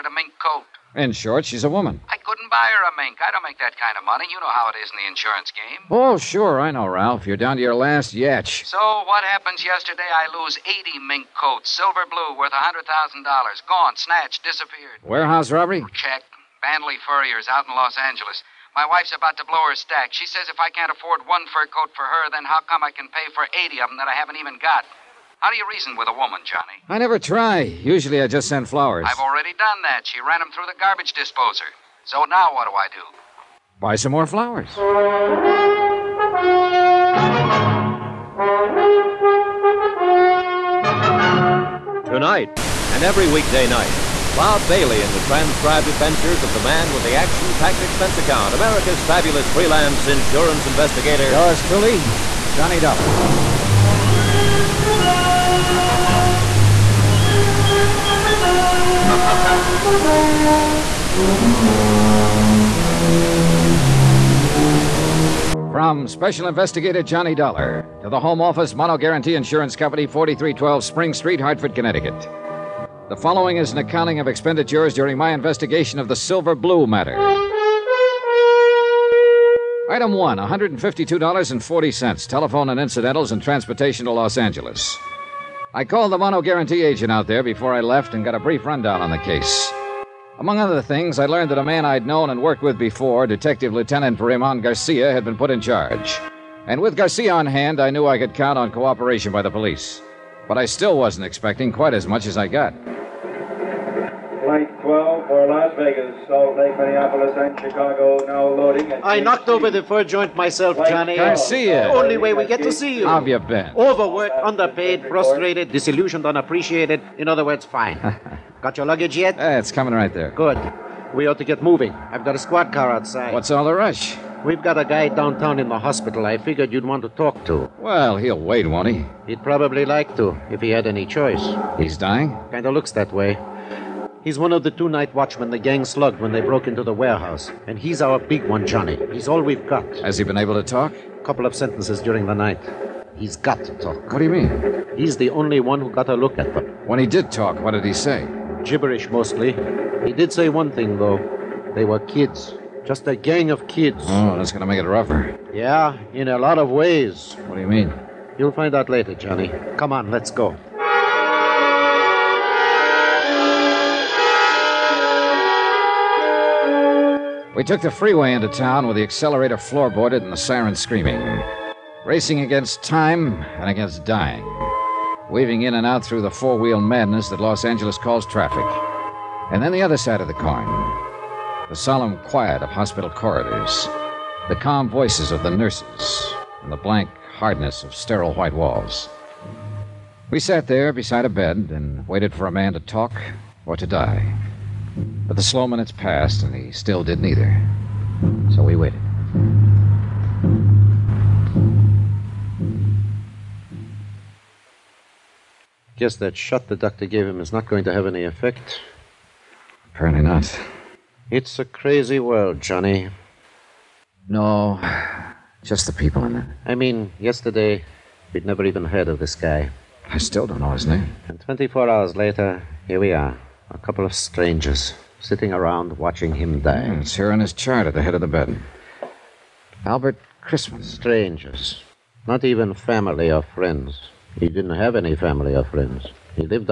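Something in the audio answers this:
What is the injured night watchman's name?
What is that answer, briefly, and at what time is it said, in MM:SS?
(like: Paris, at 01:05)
Albert Chrisman, at 03:49.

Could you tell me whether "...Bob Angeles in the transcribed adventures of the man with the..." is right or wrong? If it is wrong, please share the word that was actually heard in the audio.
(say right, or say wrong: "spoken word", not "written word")
wrong: "Bailey", not "Angeles".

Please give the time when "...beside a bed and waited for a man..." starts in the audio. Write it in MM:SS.
03:10.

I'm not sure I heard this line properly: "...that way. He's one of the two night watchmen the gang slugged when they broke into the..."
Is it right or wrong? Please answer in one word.
right.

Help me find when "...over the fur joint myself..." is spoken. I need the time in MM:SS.
01:49.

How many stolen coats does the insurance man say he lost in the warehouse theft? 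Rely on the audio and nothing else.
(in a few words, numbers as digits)
80.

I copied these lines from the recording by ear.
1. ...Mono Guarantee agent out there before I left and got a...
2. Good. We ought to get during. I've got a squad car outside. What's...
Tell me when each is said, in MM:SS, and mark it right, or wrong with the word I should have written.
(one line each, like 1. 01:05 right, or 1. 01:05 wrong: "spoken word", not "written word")
1. 01:26 right
2. 02:00 wrong: "moving", not "during".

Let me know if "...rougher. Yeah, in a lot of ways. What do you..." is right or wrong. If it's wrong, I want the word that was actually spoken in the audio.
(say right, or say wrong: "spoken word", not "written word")
right.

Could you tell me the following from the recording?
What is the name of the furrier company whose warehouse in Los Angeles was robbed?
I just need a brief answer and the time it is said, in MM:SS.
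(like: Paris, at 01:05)
Bandley Furriers, at 00:16.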